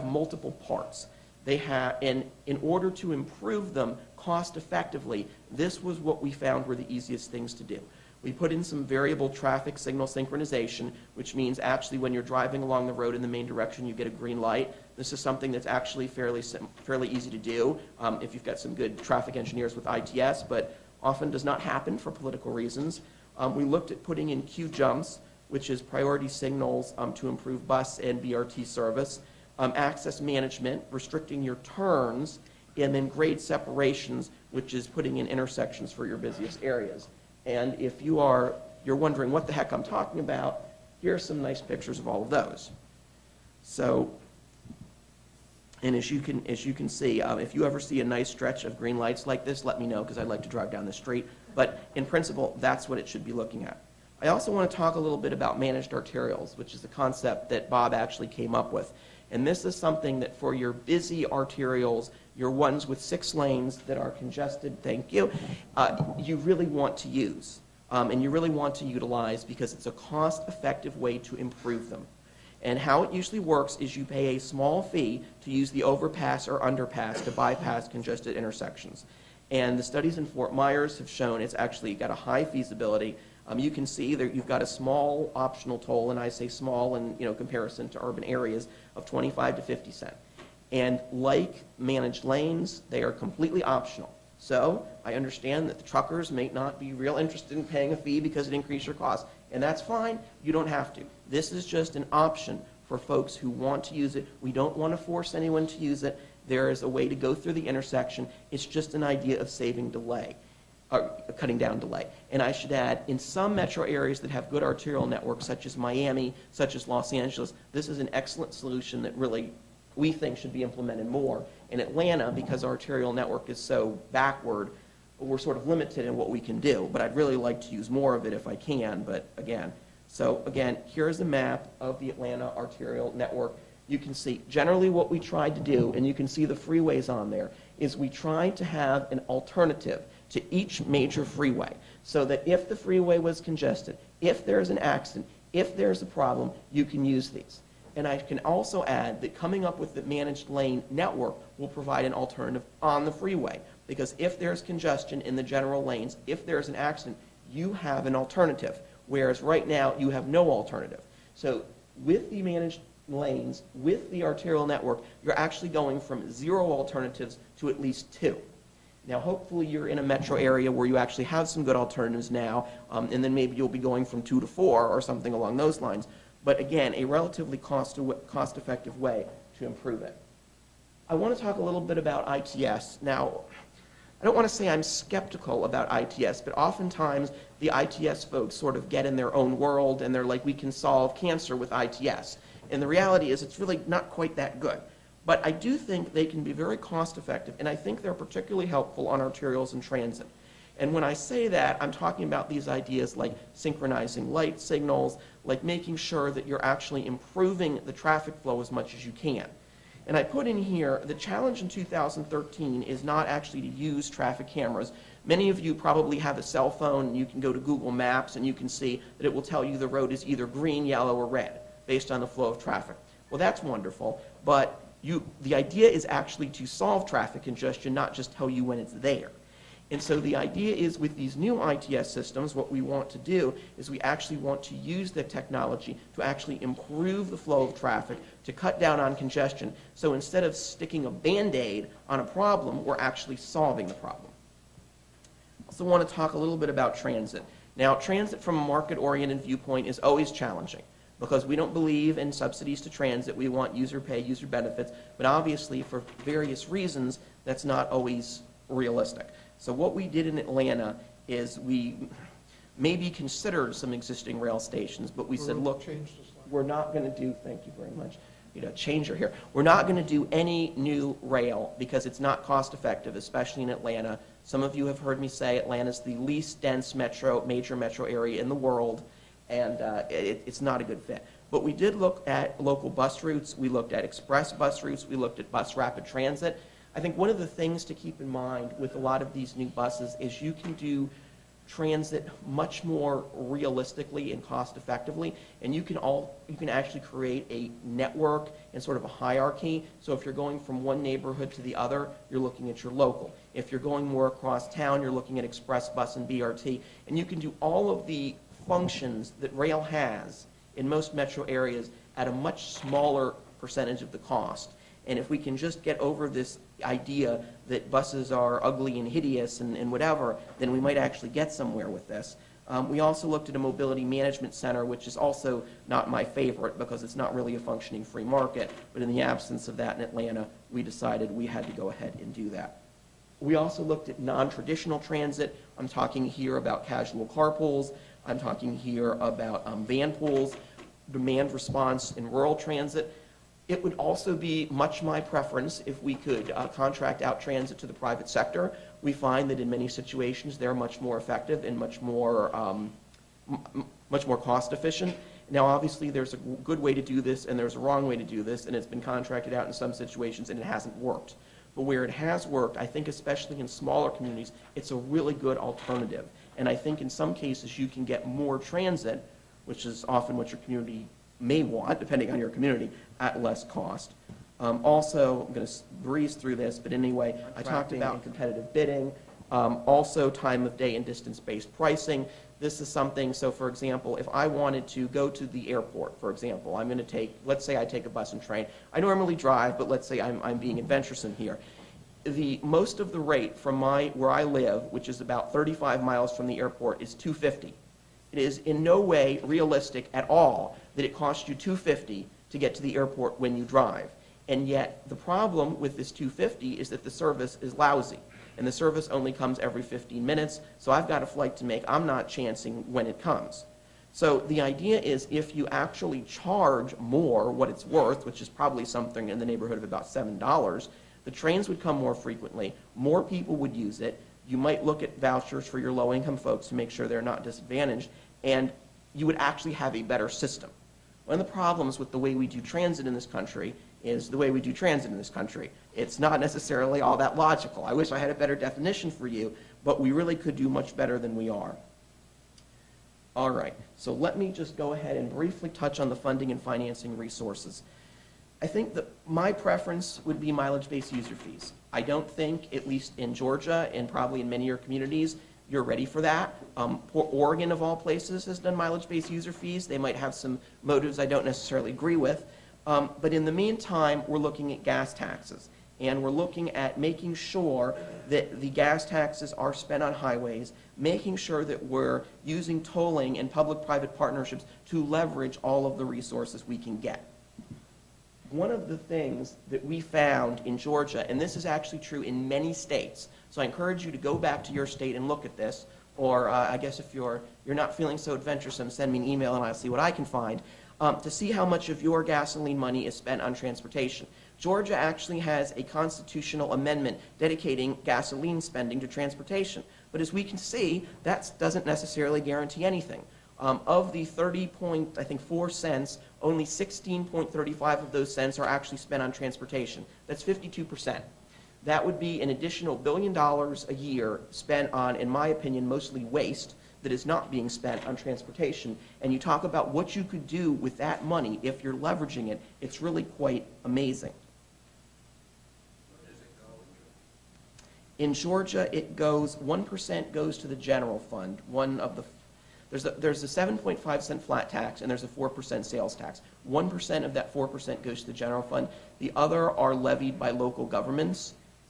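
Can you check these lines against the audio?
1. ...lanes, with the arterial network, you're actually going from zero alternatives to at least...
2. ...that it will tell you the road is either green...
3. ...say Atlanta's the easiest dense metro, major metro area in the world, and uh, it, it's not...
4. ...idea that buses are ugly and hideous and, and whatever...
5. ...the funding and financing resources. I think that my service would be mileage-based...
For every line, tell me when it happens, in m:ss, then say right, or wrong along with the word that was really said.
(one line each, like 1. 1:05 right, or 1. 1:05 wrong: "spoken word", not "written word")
1. 2:43 right
2. 3:39 right
3. 4:35 wrong: "least", not "easiest"
4. 5:16 right
5. 7:26 wrong: "preference", not "service".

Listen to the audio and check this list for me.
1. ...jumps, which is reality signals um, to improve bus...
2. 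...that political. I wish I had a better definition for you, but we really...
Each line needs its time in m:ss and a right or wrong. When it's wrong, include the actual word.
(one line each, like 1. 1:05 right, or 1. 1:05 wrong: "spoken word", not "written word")
1. 0:24 wrong: "priority", not "reality"
2. 7:17 wrong: "logical", not "political".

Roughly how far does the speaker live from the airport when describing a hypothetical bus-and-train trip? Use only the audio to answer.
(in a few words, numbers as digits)
35 miles.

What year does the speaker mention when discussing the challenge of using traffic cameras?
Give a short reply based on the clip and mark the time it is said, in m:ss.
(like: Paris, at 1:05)
2013, at 3:31.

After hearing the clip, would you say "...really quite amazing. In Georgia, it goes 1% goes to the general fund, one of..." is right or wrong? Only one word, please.
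right.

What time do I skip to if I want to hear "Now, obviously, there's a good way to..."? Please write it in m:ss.
5:55.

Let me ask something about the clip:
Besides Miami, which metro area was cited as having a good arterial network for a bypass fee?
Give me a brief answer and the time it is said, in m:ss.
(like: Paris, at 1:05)
Los Angeles, at 1:56.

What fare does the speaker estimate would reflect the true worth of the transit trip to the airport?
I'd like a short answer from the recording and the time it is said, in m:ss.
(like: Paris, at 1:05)
$7, at 7:00.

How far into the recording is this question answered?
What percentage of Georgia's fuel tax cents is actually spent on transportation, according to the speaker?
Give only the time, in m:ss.
8:30.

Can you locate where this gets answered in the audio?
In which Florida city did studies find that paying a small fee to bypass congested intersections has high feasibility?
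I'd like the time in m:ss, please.
1:20.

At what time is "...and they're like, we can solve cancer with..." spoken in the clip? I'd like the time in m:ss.
3:09.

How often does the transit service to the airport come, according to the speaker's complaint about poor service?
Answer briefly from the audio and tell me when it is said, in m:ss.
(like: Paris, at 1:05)
every 15 minutes, at 6:49.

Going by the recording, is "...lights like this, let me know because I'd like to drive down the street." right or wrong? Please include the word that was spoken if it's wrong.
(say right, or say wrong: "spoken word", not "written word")
right.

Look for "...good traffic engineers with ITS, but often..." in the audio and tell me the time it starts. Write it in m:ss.
0:18.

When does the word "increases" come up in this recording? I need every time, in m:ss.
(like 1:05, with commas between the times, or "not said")
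1:38.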